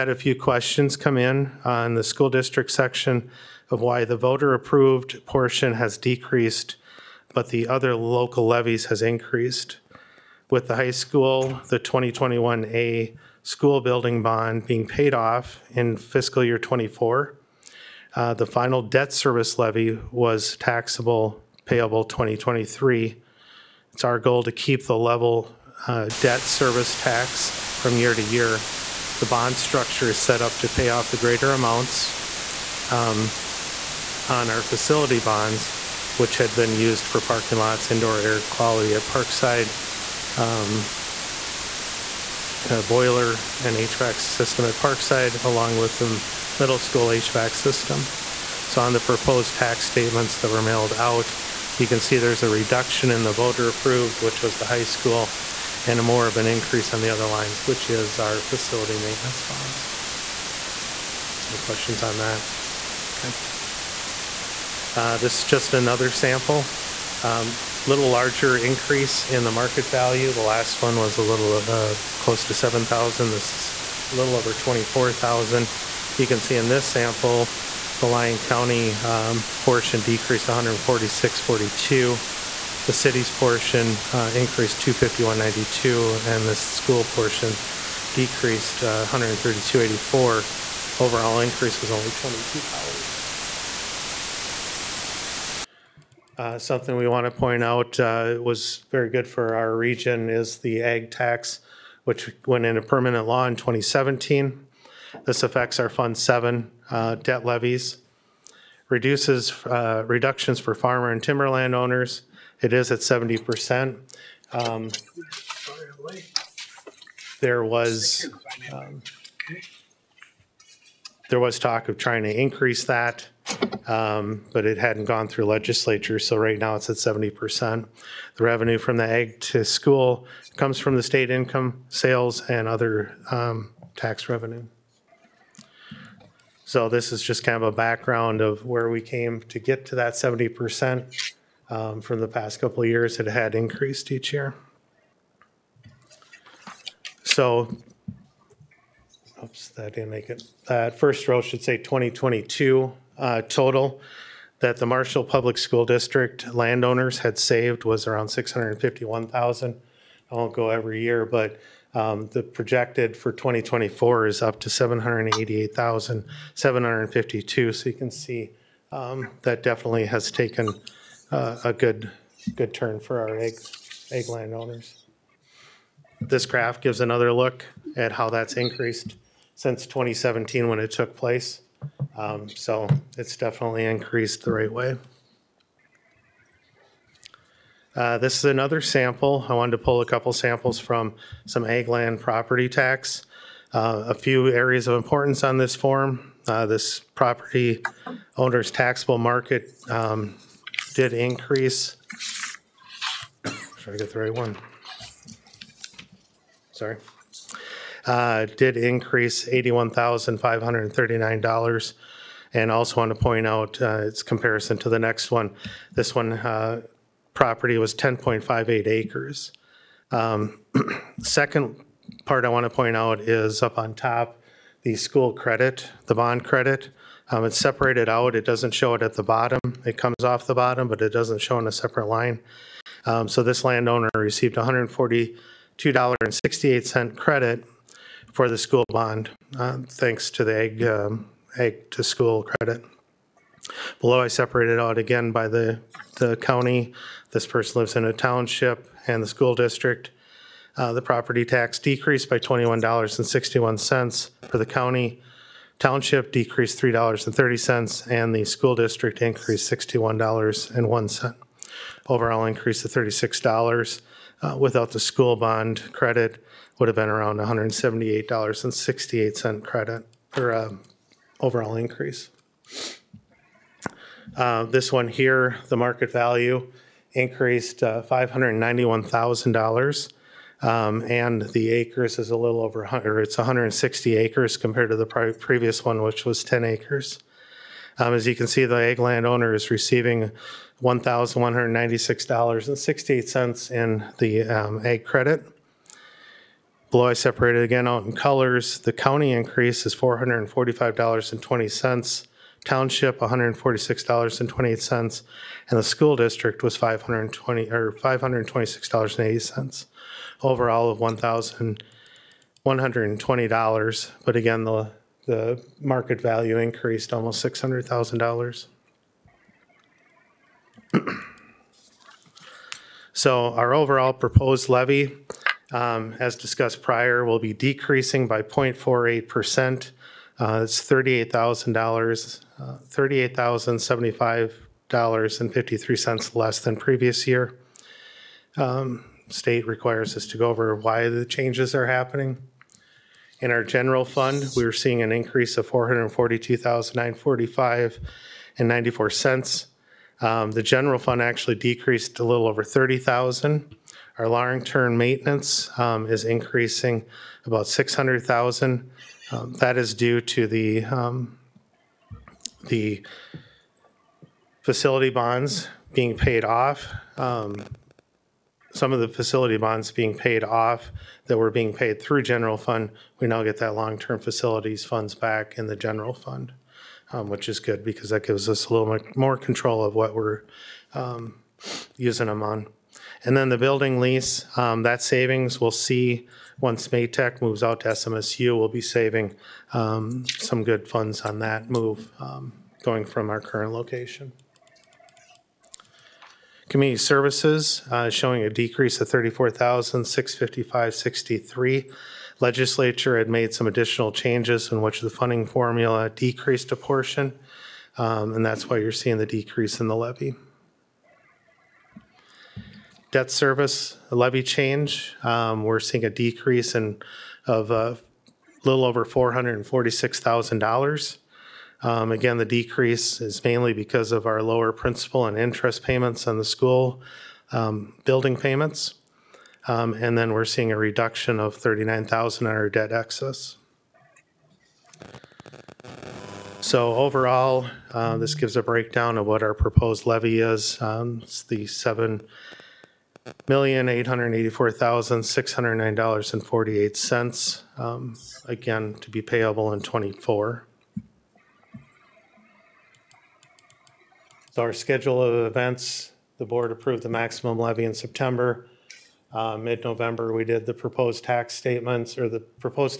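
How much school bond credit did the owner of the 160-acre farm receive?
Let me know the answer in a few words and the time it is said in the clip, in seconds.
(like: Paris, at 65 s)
$1,196.68, at 290 s.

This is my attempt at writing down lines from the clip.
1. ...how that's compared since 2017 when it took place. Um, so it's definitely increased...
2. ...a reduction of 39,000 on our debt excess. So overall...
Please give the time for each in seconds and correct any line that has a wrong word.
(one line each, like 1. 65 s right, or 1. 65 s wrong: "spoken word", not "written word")
1. 178 s wrong: "increased", not "compared"
2. 430 s right.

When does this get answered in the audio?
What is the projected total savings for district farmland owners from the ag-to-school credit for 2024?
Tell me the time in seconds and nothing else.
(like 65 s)
164 s.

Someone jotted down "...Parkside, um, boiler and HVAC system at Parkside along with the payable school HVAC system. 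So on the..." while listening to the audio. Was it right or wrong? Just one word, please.
wrong.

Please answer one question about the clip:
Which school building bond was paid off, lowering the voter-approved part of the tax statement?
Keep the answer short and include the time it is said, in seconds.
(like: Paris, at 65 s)
2021A, at 11 s.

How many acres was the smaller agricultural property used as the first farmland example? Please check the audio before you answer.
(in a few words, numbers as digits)
10.58 acres.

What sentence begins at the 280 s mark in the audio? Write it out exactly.
Um, and the acres is a little over 100, it's 160 acres compared to the previous one, which was 10 acres.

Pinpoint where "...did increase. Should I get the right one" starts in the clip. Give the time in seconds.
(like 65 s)
200 s.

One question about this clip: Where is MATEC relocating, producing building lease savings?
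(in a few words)
SMSU.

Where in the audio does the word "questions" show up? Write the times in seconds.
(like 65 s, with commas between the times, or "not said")
0 s, 61 s.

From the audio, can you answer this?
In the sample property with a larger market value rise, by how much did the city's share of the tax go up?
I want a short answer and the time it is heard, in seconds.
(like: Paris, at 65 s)
$251.92, at 84 s.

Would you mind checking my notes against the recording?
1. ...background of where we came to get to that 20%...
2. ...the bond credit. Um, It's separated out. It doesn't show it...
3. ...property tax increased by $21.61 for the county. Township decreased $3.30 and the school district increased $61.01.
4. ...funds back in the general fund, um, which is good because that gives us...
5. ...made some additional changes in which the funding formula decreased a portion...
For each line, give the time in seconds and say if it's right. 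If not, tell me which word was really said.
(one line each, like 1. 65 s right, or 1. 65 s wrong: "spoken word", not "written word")
1. 137 s wrong: "70", not "20"
2. 226 s right
3. 251 s wrong: "decreased", not "increased"
4. 374 s right
5. 403 s right.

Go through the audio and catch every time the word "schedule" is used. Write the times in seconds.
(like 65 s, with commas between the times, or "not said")
454 s.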